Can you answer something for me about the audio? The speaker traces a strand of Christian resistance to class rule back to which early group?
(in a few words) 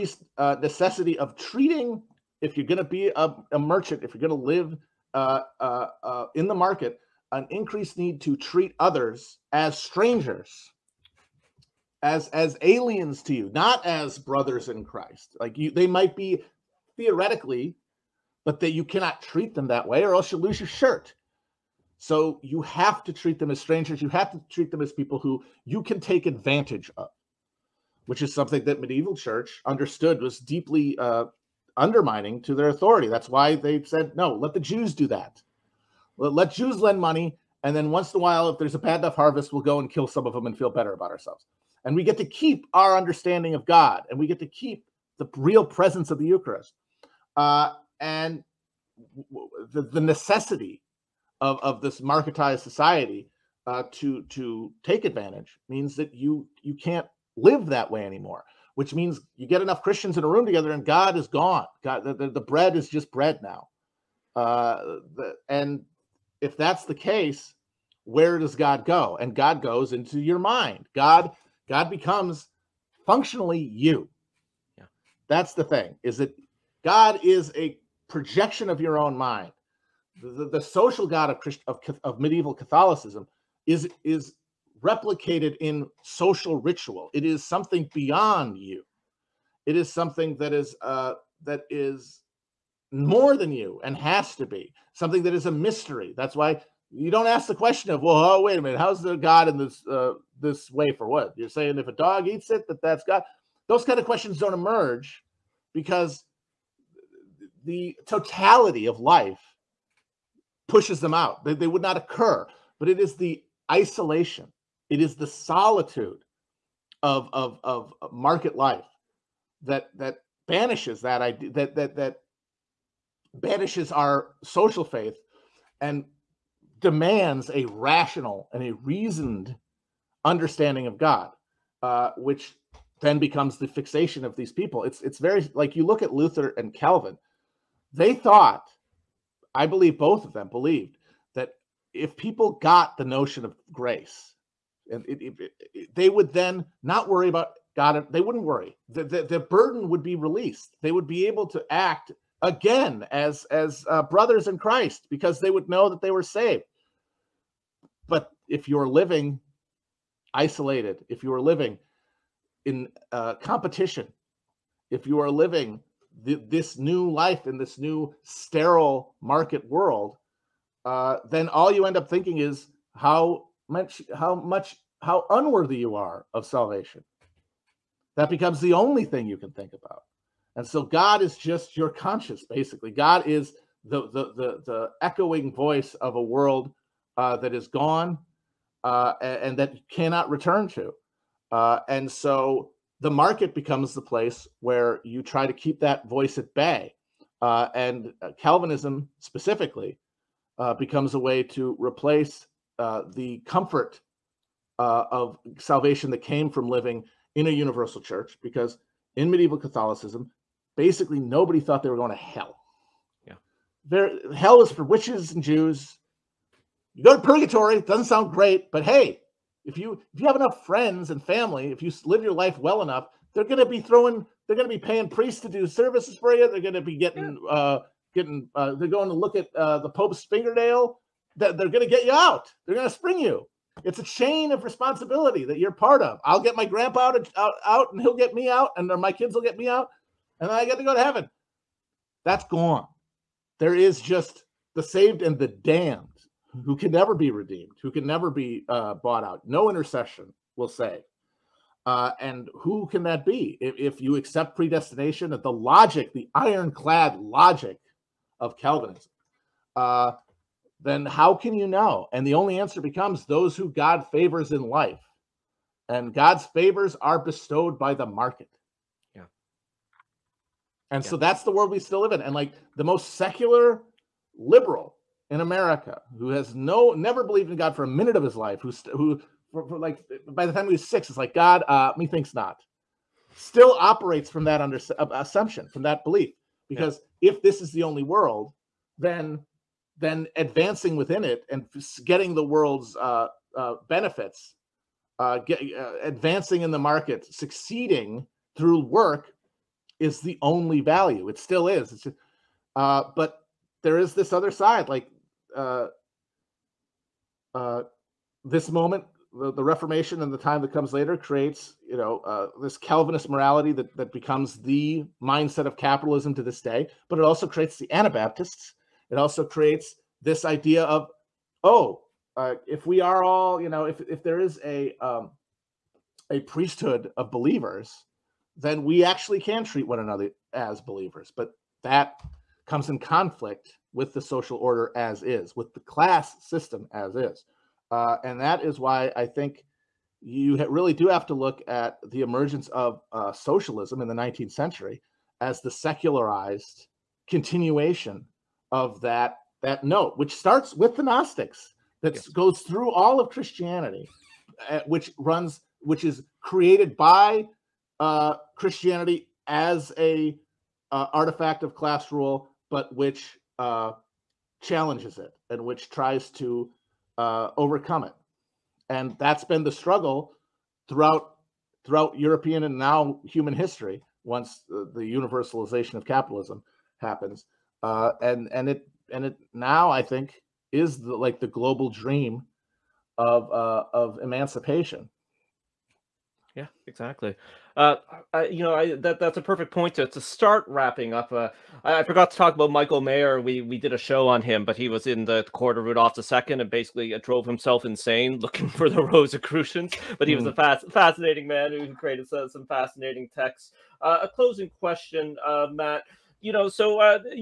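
The Gnostics.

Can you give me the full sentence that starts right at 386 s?
Yeah, exactly uh, you know, I, that that's a perfect point to, to start wrapping up.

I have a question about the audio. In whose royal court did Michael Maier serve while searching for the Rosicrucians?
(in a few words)
Rudolph II.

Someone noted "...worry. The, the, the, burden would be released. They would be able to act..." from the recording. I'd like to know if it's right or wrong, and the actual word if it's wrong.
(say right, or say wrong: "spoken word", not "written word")
right.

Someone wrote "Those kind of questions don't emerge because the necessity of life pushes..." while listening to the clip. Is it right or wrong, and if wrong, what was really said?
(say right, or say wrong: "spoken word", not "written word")
wrong: "totality", not "necessity".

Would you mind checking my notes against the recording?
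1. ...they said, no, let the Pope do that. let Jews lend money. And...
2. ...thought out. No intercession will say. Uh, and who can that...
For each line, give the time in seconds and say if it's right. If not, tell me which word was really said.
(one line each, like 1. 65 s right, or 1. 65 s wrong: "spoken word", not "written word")
1. 33 s wrong: "Jews", not "Pope"
2. 248 s wrong: "bought", not "thought".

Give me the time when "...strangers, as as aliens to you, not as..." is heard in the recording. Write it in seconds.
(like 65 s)
9 s.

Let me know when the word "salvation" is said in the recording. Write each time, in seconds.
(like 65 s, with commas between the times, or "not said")
176 s, 205 s.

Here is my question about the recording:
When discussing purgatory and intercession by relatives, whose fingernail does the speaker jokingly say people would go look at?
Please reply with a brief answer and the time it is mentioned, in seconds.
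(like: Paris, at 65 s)
The Pope's, at 229 s.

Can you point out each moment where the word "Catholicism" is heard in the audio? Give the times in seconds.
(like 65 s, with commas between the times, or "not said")
82 s, 209 s.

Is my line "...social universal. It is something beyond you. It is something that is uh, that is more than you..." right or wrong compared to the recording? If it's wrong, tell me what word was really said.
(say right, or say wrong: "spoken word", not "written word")
wrong: "ritual", not "universal".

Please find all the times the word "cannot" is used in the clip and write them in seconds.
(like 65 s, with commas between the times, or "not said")
18 s, 189 s.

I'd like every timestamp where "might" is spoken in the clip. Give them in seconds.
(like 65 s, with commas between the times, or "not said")
15 s.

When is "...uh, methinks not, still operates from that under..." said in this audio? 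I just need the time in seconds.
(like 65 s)
281 s.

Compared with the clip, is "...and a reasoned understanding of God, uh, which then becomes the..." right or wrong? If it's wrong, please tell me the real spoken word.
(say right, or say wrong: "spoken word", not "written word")
right.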